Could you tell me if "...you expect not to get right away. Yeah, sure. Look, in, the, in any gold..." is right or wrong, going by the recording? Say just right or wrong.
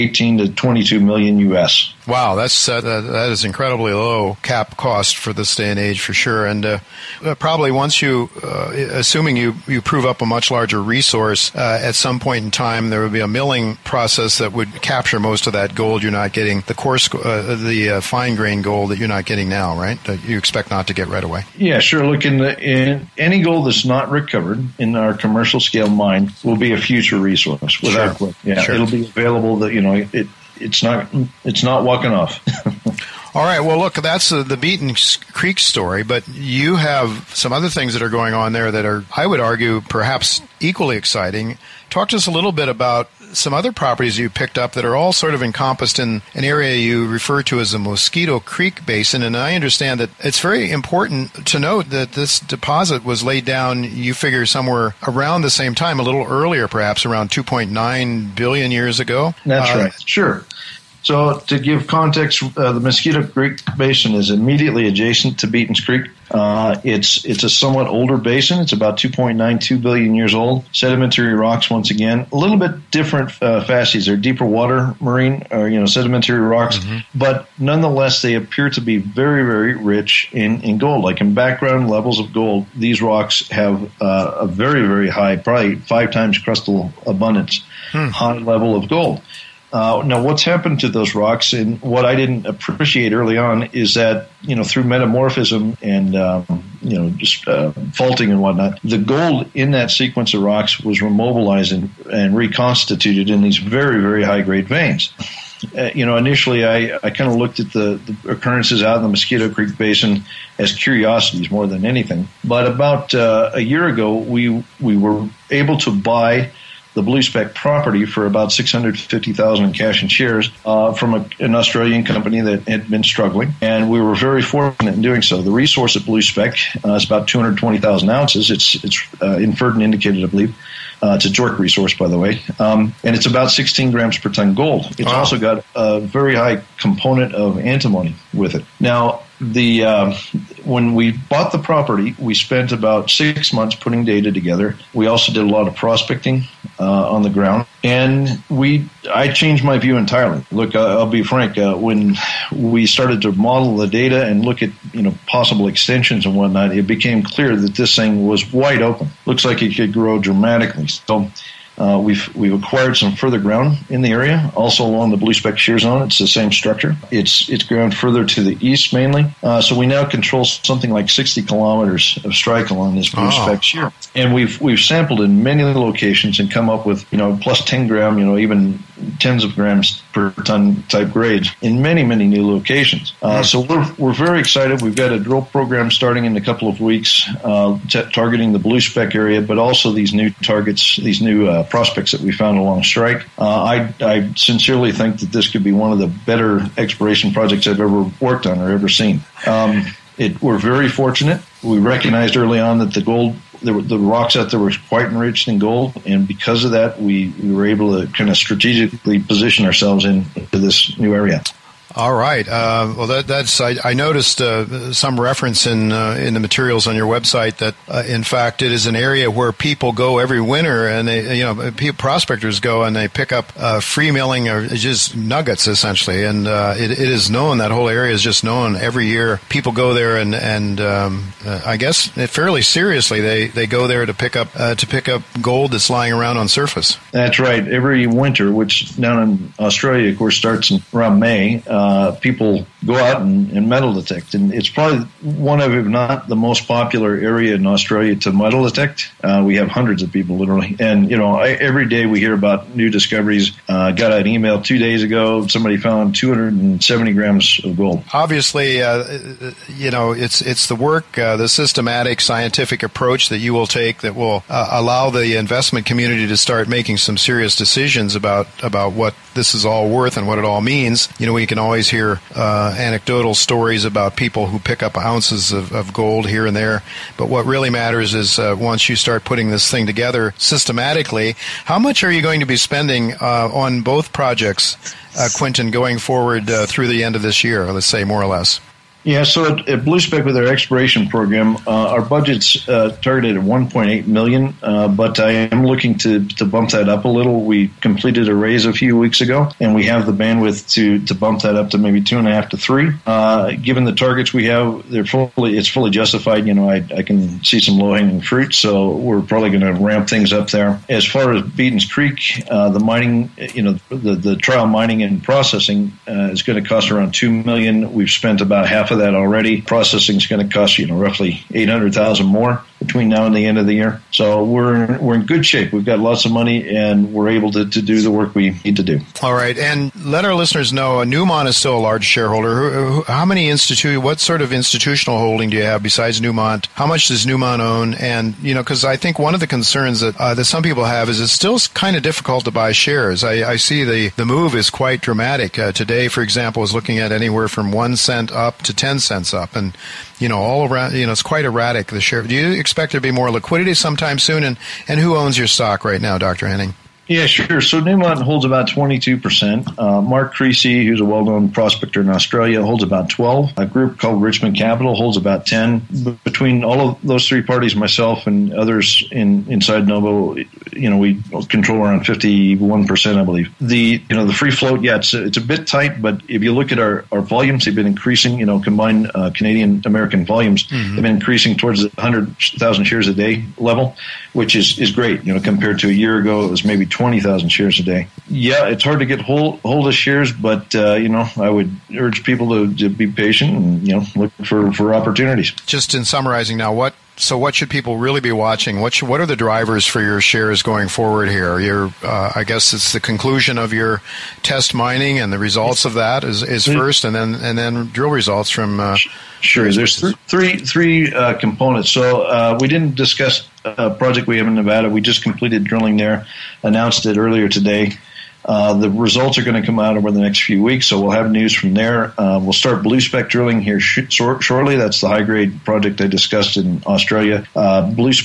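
right.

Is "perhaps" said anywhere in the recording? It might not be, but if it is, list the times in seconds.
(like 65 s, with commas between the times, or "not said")
39 s, 56 s.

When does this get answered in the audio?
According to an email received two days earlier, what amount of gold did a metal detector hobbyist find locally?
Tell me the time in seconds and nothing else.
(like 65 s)
256 s.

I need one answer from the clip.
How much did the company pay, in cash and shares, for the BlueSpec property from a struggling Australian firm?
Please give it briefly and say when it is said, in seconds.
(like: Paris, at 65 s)
650,000, at 118 s.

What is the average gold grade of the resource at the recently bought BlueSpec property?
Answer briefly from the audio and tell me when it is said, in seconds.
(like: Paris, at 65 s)
16 grams per ton, at 133 s.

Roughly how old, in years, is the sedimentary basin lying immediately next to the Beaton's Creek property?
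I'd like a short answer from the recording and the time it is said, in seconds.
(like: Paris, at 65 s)
2.92 billion years, at 68 s.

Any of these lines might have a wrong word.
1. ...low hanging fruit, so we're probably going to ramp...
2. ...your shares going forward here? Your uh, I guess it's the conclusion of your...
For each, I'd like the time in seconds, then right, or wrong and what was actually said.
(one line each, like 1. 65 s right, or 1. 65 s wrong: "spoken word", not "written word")
1. 307 s right
2. 400 s right.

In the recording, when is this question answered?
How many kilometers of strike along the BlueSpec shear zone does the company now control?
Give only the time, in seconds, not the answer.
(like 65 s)
171 s.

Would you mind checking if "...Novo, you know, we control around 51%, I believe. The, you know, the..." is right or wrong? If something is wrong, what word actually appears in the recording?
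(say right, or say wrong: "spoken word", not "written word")
right.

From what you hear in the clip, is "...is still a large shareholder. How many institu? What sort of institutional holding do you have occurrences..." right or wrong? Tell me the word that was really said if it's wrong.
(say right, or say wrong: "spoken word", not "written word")
wrong: "besides", not "occurrences".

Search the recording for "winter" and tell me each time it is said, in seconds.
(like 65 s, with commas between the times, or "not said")
220 s, 238 s.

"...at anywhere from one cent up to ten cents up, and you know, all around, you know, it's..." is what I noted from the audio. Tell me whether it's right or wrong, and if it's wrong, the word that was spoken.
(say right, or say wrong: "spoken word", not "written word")
right.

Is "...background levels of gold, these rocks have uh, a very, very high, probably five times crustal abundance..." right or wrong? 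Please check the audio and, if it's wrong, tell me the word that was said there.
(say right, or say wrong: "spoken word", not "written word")
right.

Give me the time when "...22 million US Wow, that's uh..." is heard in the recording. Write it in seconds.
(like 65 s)
0 s.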